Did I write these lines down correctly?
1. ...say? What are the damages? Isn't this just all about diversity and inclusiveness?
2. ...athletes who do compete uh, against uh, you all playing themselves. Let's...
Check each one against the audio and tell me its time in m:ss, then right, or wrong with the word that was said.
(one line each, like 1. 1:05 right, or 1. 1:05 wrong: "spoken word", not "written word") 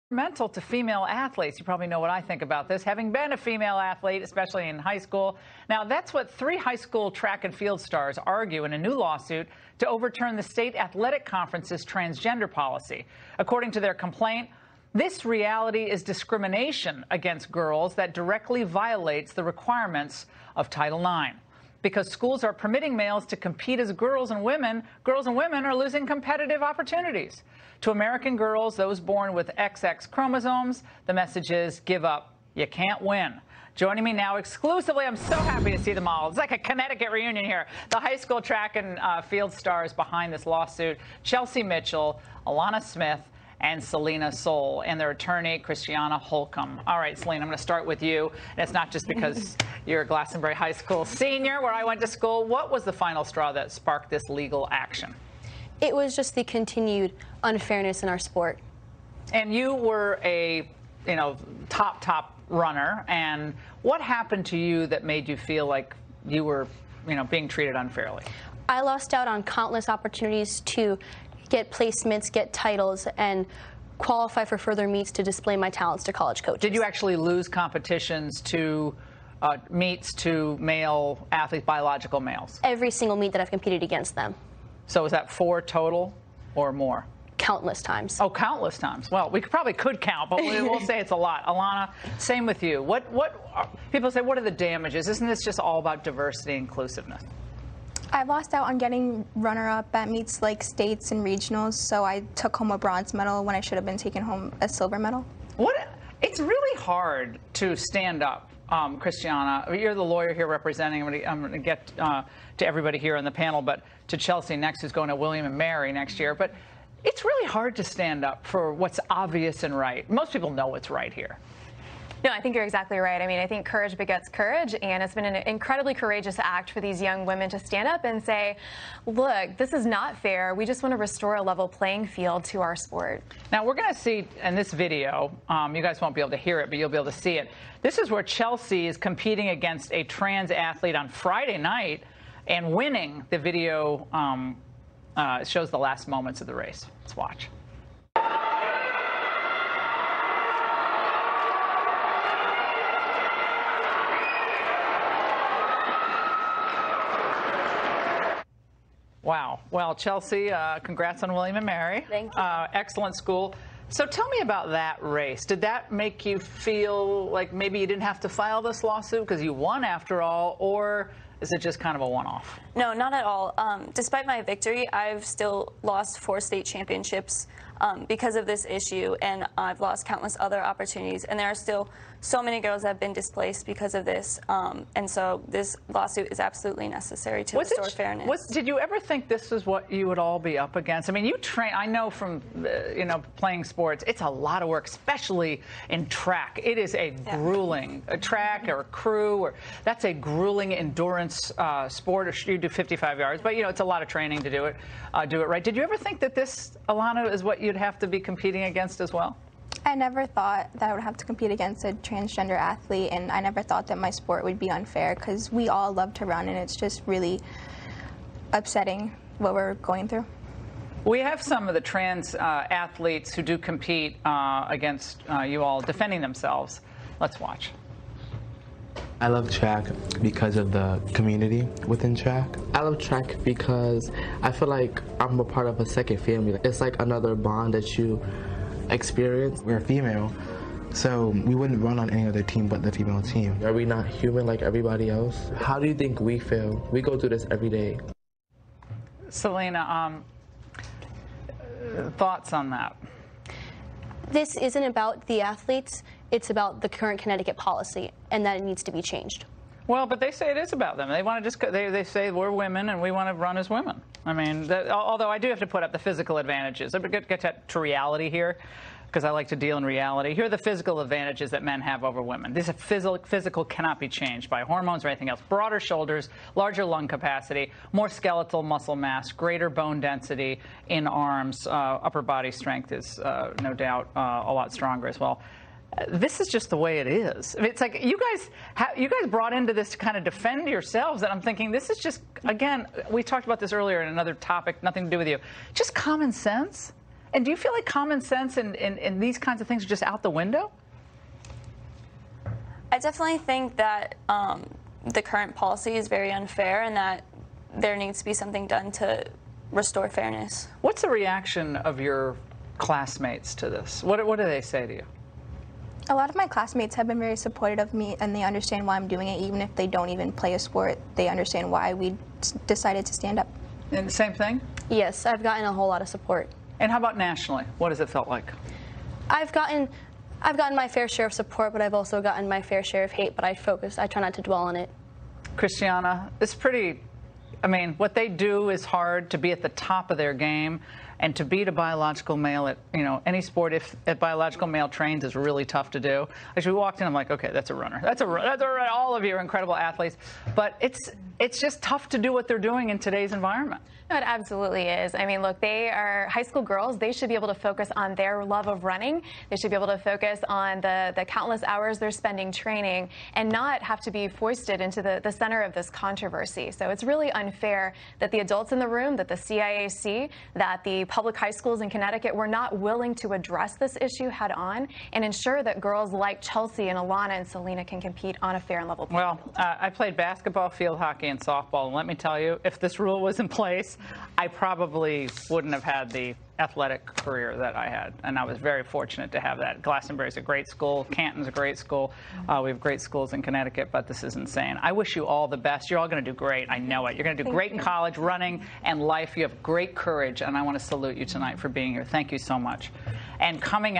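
1. 1:34 right
2. 3:42 wrong: "defending", not "playing".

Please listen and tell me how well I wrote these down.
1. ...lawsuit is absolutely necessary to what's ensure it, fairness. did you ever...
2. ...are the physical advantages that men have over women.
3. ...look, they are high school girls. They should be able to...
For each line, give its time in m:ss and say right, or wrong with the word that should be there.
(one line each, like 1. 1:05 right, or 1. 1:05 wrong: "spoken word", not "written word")
1. 3:05 wrong: "restore", not "ensure"
2. 4:30 right
3. 5:55 right.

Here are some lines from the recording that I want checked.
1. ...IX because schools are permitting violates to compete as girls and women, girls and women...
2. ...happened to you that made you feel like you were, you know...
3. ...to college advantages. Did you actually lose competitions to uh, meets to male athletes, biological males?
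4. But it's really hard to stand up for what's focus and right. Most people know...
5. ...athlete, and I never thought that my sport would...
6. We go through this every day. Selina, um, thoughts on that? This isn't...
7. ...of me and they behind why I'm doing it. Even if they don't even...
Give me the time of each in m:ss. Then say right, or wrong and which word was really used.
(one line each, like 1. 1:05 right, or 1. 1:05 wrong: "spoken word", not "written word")
1. 0:20 wrong: "males", not "violates"
2. 1:04 right
3. 1:16 wrong: "coaches", not "advantages"
4. 1:56 wrong: "obvious", not "focus"
5. 3:32 right
6. 4:06 right
7. 5:17 wrong: "understand", not "behind".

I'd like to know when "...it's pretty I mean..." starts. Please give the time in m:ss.
5:36.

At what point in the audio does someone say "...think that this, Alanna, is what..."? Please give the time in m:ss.
3:25.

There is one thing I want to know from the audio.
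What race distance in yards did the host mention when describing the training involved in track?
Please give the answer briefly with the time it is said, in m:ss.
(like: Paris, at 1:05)
55 yards, at 3:22.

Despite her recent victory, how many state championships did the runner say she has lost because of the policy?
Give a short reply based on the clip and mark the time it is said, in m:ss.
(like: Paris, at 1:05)
4, at 2:56.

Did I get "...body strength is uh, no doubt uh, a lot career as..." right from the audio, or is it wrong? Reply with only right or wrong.
wrong.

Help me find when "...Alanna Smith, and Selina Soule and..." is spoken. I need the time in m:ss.
0:42.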